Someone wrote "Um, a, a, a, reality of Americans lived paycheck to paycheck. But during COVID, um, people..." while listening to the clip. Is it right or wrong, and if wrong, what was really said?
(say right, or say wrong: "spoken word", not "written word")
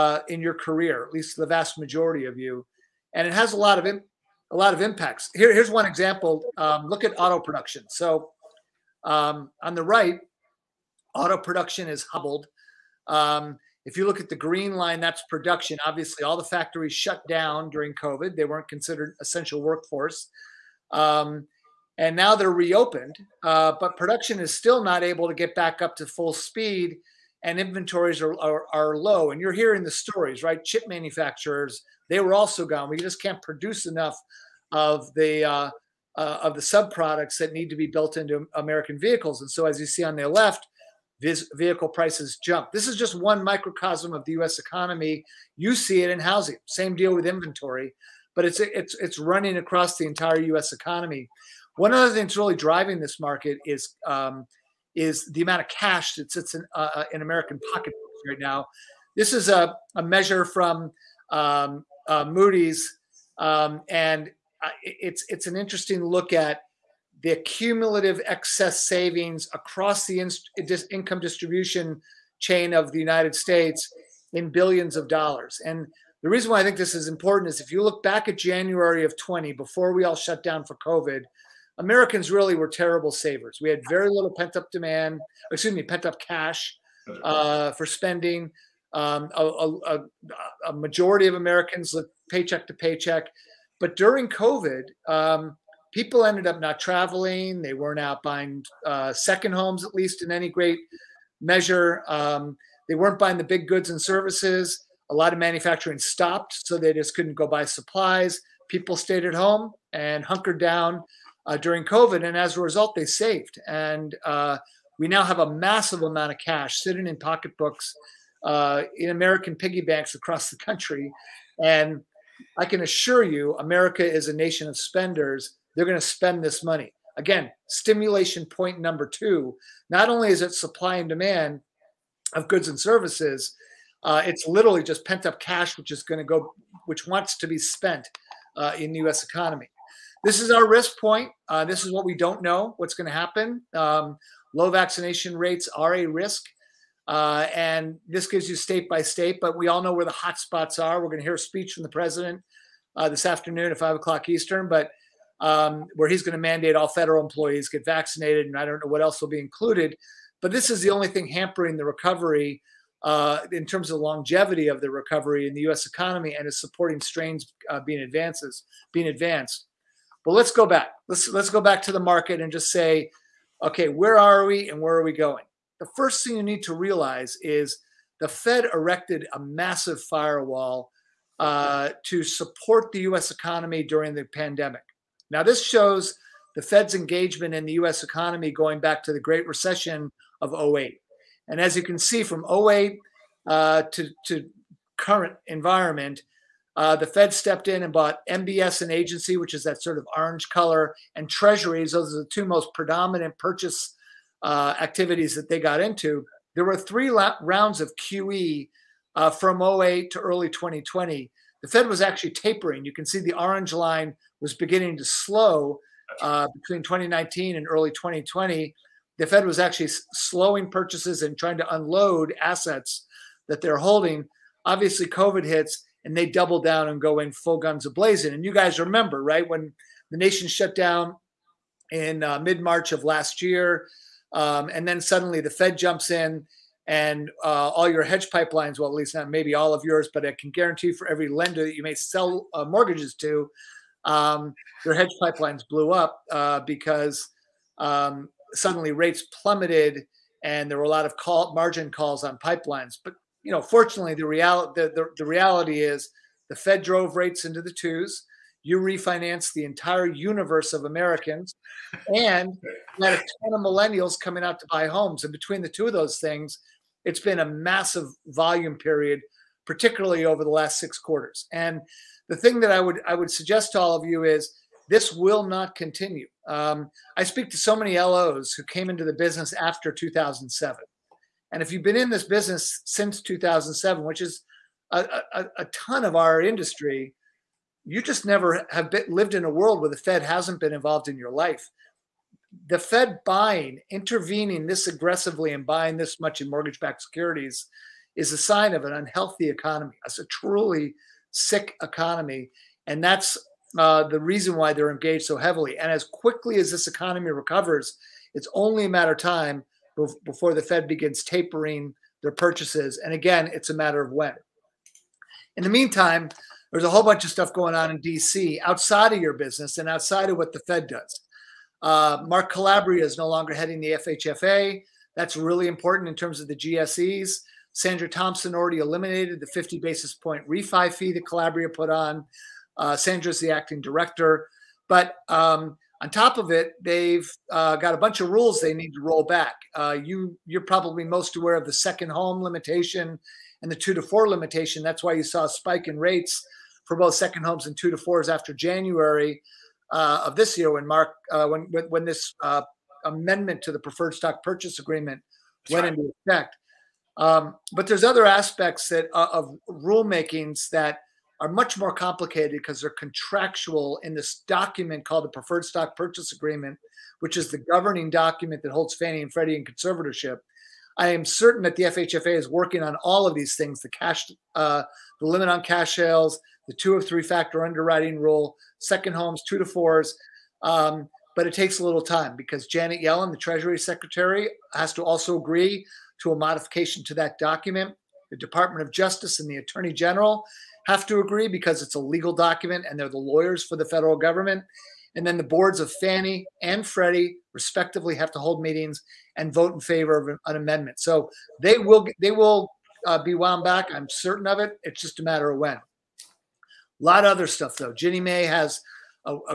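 wrong: "majority", not "reality".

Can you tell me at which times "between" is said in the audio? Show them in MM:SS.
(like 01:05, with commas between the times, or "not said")
03:36, 04:25.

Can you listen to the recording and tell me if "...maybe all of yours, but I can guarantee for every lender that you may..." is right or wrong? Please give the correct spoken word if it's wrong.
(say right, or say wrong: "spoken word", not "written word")
right.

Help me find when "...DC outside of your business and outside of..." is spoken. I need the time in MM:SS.
05:17.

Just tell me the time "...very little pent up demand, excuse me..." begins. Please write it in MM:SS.
01:23.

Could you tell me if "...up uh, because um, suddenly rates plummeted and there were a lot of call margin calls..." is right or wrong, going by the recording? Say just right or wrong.
right.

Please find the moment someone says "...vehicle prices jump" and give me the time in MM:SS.
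00:41.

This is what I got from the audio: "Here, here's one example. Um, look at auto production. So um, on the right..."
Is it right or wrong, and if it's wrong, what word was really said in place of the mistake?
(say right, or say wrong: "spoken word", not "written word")
right.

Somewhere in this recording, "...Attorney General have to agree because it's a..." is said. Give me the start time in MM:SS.
06:29.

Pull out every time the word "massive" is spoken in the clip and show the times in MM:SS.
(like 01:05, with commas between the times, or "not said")
01:55, 02:59, 04:27.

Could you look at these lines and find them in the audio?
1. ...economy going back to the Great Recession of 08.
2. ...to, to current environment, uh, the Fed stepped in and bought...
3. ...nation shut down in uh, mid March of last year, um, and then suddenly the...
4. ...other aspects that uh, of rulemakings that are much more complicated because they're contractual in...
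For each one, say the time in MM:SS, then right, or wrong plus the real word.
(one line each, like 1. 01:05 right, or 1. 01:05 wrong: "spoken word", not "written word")
1. 03:08 right
2. 03:13 right
3. 03:50 right
4. 05:58 right.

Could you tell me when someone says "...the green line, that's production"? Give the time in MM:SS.
00:14.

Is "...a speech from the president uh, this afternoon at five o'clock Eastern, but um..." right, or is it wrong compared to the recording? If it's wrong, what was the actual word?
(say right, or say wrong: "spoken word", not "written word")
right.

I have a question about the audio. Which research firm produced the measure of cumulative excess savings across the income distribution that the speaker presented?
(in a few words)
Moody's.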